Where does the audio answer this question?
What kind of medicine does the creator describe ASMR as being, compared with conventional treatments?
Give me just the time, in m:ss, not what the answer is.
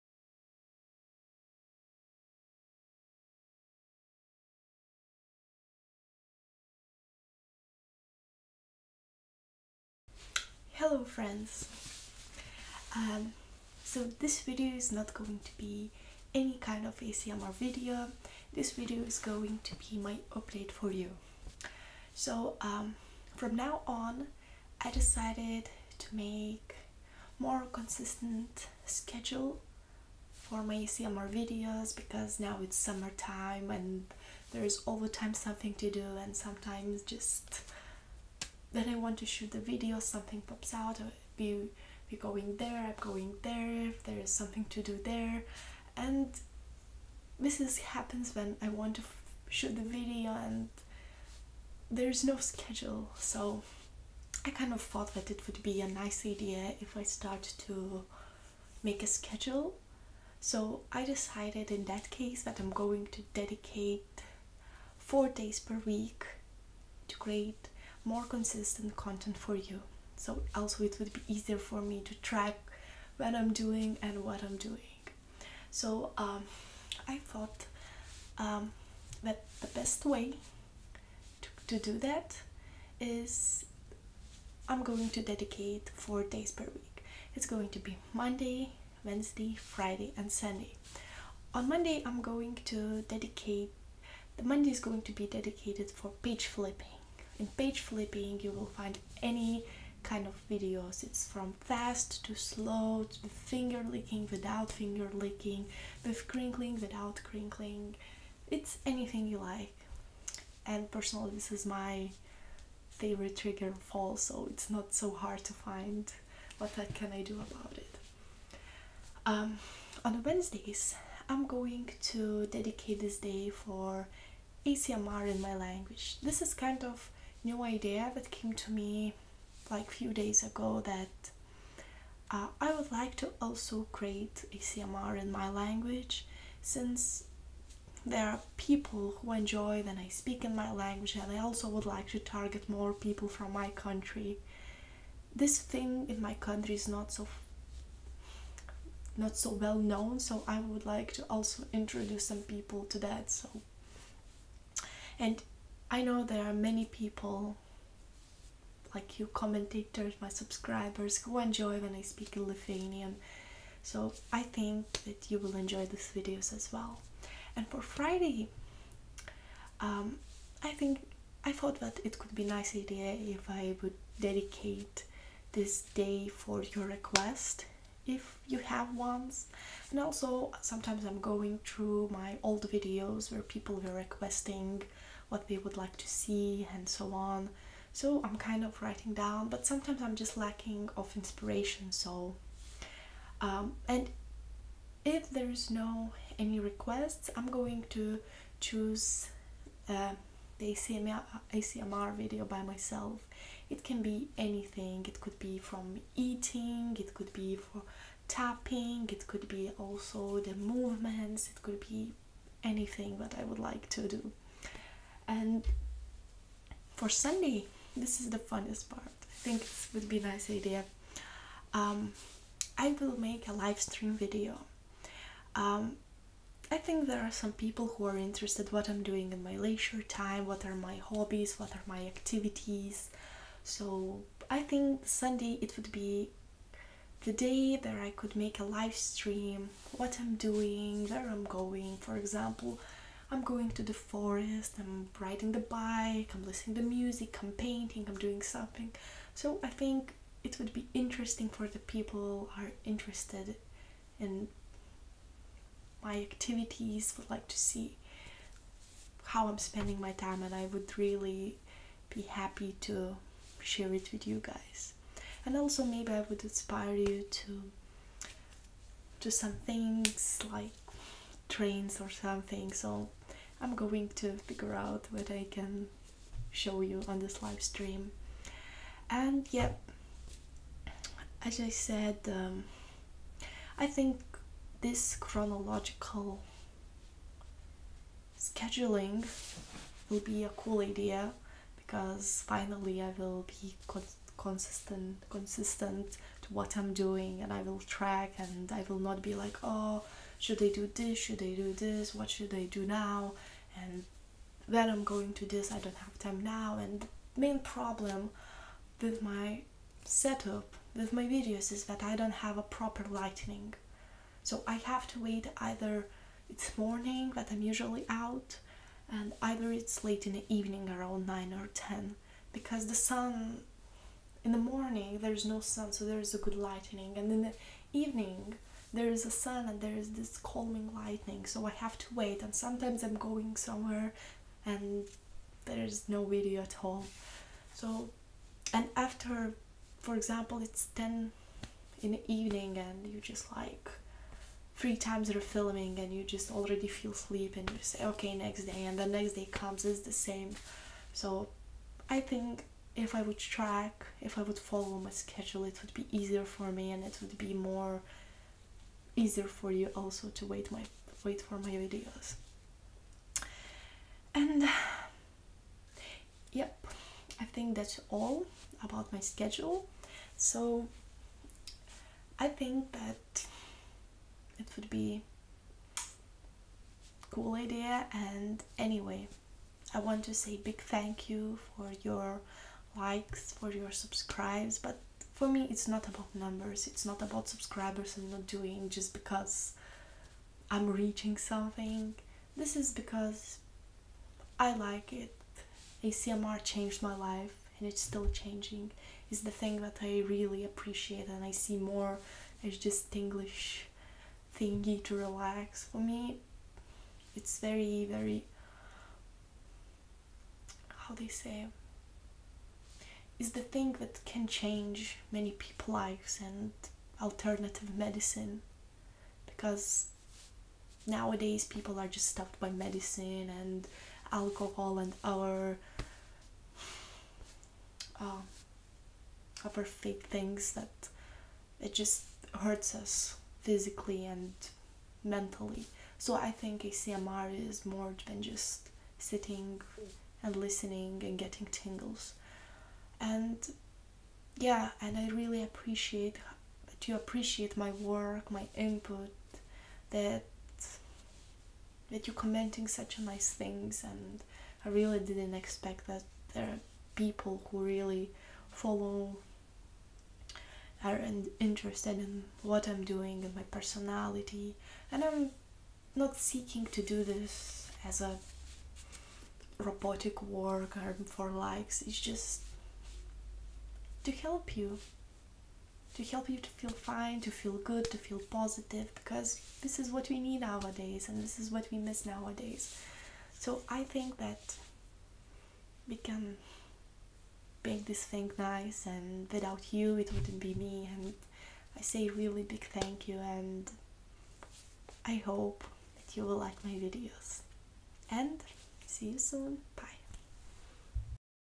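6:57.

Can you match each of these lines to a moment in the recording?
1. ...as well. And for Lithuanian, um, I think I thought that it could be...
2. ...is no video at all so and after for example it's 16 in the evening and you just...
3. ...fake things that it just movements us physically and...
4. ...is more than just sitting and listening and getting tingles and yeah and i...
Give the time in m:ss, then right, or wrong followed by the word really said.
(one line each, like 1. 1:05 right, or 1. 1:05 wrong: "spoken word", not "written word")
1. 2:46 wrong: "Friday", not "Lithuanian"
2. 5:35 wrong: "10", not "16"
3. 7:09 wrong: "hurts", not "movements"
4. 7:17 right.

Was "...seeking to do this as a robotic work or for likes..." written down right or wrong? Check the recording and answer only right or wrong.
right.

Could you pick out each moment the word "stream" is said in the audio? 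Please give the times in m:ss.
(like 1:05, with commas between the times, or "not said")
3:43, 3:58, 4:37.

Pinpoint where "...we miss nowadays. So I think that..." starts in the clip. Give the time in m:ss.
8:01.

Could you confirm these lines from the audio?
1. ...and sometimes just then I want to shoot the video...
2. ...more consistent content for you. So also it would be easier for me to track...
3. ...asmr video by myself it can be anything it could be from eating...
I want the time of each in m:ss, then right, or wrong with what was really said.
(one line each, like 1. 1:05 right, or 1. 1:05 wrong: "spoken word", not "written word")
1. 0:36 right
2. 1:08 right
3. 3:21 right.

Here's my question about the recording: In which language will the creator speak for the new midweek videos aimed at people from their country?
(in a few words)
Lithuanian.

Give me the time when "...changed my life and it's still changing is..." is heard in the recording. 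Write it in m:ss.
6:36.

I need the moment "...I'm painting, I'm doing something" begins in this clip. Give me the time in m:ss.
4:07.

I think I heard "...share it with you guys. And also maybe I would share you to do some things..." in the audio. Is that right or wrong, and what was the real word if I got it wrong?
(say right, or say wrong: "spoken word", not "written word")
wrong: "inspire", not "share".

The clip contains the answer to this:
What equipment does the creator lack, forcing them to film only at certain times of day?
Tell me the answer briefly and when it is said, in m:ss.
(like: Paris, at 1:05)
Proper lighting, at 5:12.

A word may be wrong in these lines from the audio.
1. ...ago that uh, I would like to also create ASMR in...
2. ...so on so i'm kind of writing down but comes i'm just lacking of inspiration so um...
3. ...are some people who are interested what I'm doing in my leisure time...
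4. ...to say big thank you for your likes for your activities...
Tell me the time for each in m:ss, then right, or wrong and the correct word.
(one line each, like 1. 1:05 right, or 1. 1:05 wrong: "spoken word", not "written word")
1. 2:10 right
2. 3:06 wrong: "sometimes", not "comes"
3. 3:47 right
4. 6:20 wrong: "subscribes", not "activities".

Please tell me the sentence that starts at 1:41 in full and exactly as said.
It's from fast to slow, to finger licking without finger licking, with crinkling without crinkling.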